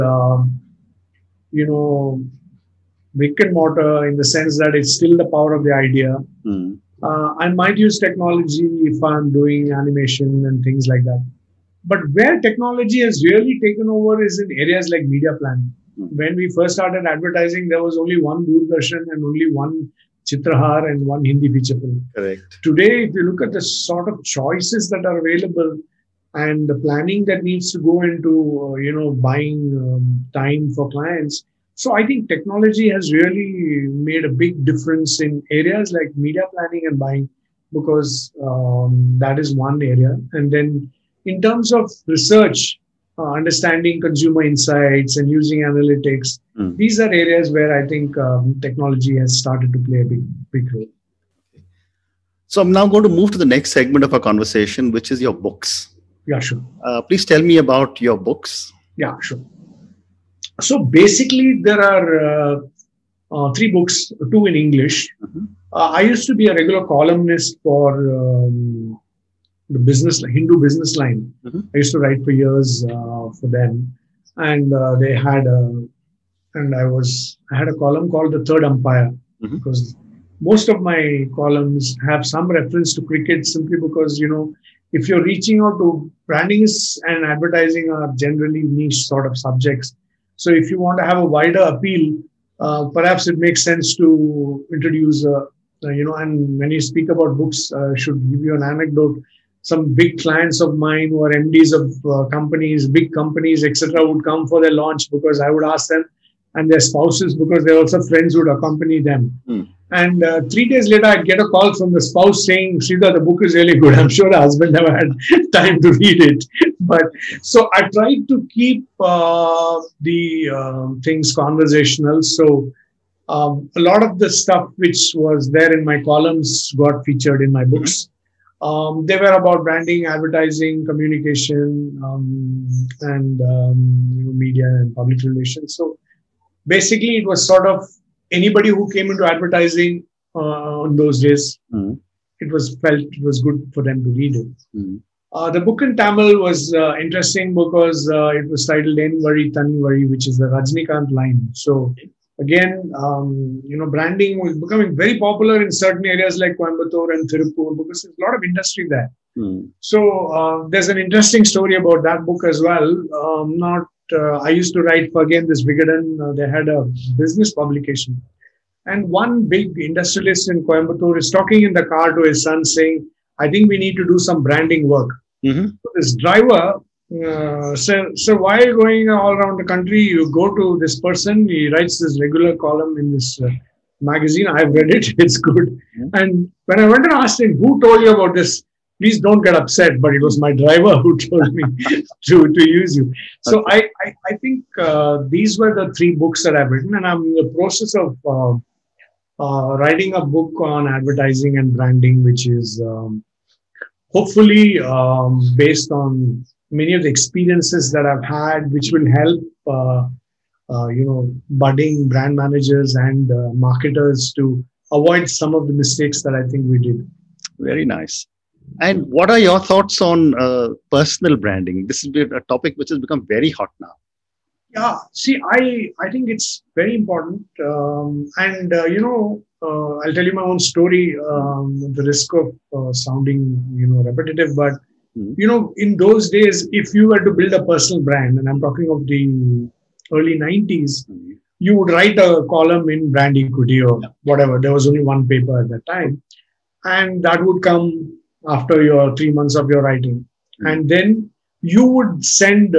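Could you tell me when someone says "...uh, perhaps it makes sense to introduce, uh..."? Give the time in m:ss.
1:32.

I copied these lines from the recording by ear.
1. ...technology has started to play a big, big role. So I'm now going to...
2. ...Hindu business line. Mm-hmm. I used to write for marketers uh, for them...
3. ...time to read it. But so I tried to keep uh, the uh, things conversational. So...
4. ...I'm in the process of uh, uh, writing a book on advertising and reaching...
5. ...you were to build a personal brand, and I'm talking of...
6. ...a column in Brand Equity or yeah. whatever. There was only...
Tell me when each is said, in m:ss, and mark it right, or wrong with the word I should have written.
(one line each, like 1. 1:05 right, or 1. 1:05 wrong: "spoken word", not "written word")
1. 0:48 right
2. 1:10 wrong: "years", not "marketers"
3. 1:55 right
4. 3:17 wrong: "branding", not "reaching"
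5. 3:56 right
6. 4:02 right.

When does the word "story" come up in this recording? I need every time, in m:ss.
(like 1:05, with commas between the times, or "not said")
2:41, 3:50.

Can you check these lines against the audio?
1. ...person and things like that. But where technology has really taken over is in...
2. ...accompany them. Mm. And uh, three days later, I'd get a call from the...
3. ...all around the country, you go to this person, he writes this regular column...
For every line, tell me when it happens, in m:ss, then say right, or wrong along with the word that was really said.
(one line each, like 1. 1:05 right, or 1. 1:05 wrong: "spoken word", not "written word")
1. 0:09 wrong: "animation", not "person"
2. 1:48 right
3. 2:59 right.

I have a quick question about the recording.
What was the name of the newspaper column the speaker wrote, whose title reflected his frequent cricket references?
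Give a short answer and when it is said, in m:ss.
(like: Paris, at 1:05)
Third Umpire, at 1:18.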